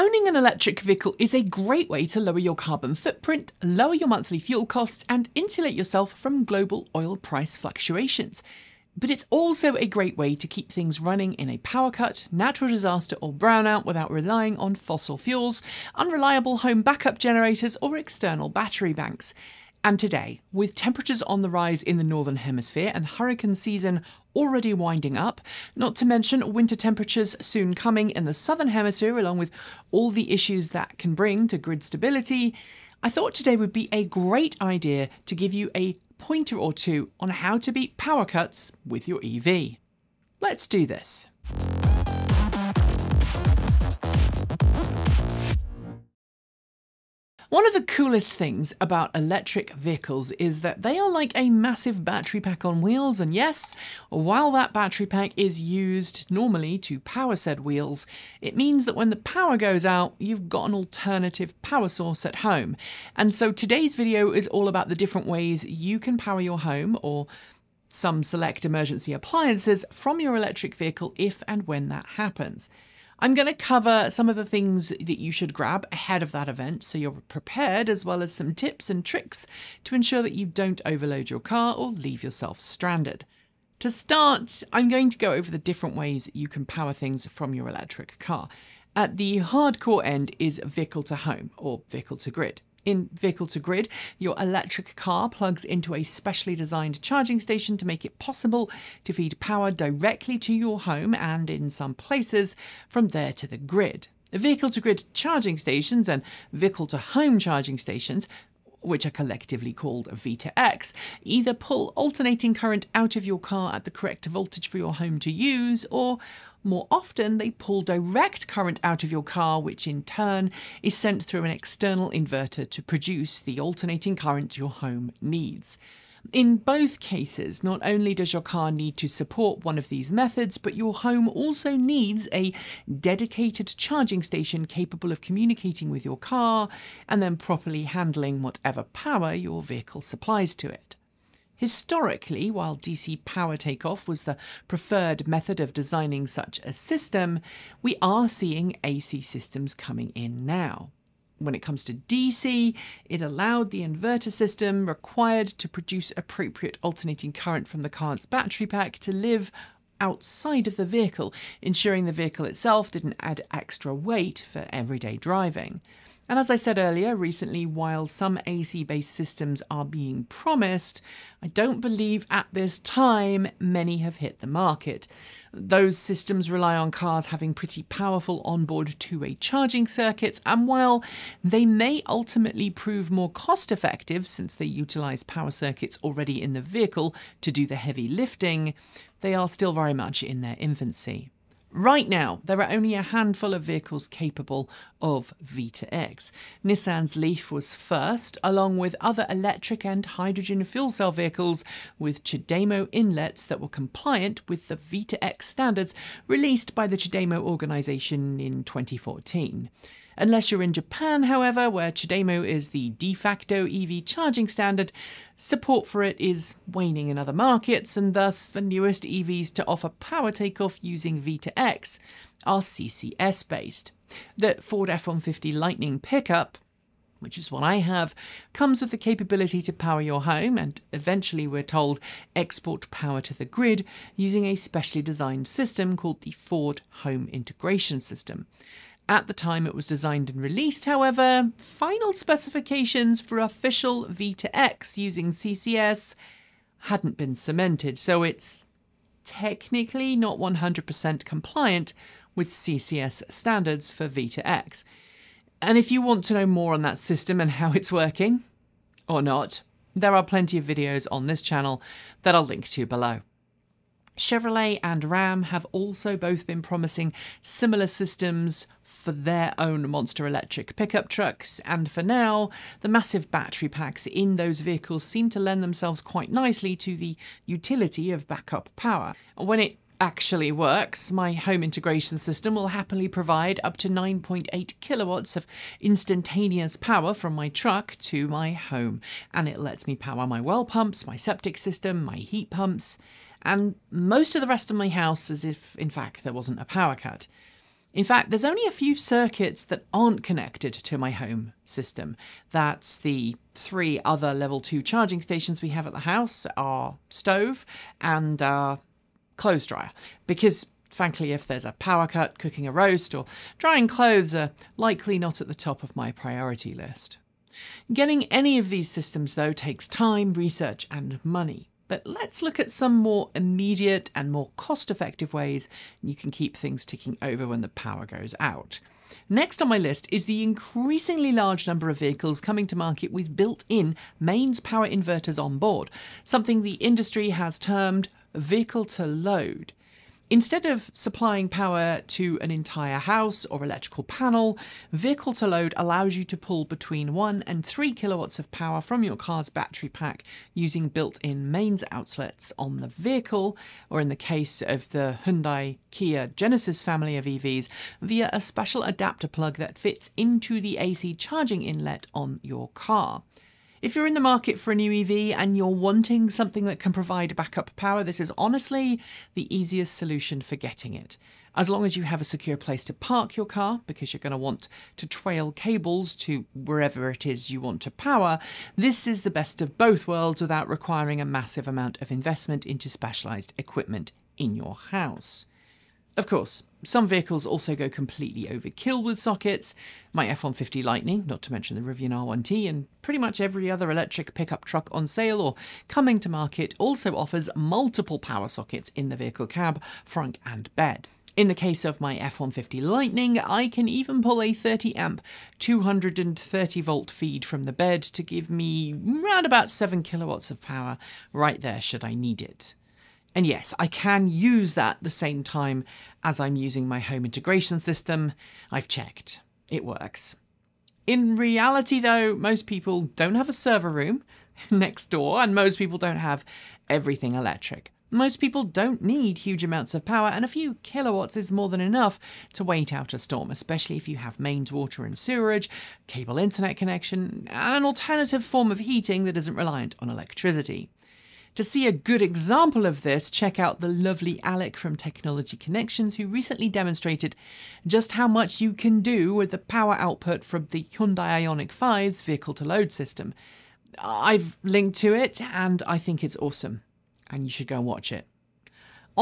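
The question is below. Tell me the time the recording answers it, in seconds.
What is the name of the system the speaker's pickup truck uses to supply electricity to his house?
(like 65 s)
236 s.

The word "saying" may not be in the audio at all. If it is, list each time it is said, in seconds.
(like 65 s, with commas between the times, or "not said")
not said.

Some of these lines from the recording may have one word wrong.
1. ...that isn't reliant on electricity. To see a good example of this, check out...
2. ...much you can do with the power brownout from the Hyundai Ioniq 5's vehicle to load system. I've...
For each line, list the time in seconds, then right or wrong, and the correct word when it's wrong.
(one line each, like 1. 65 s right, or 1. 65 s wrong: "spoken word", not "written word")
1. 439 s right
2. 448 s wrong: "output", not "brownout".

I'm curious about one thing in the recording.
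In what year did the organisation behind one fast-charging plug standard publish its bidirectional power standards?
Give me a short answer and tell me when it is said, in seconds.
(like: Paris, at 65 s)
2014, at 208 s.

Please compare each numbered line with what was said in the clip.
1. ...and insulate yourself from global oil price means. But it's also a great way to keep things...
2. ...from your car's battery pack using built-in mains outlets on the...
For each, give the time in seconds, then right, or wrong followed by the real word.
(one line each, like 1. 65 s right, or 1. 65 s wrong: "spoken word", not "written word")
1. 5 s wrong: "fluctuations", not "means"
2. 348 s right.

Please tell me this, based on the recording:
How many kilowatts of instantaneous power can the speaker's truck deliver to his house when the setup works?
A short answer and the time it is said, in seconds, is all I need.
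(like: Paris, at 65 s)
9.8 kilowatts, at 283 s.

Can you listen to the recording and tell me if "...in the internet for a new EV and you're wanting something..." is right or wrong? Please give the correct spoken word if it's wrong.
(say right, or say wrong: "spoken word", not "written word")
wrong: "market", not "internet".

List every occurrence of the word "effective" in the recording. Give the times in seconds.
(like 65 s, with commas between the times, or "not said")
183 s, 324 s.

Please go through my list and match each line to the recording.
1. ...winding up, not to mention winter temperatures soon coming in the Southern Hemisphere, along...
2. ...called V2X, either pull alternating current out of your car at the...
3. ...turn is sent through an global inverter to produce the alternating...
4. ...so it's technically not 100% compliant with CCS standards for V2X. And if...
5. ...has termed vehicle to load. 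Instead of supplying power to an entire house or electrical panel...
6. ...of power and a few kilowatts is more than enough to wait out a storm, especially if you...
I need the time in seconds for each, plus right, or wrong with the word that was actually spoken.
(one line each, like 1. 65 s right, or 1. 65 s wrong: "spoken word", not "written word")
1. 24 s right
2. 109 s right
3. 120 s wrong: "external", not "global"
4. 247 s right
5. 337 s right
6. 429 s right.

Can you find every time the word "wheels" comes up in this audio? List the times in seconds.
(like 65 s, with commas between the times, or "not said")
52 s, 57 s.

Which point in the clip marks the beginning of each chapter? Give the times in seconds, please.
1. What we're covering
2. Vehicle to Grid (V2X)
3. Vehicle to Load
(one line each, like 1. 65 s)
1. 46 s
2. 87 s
3. 328 s.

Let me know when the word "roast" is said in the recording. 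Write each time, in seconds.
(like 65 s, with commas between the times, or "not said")
312 s.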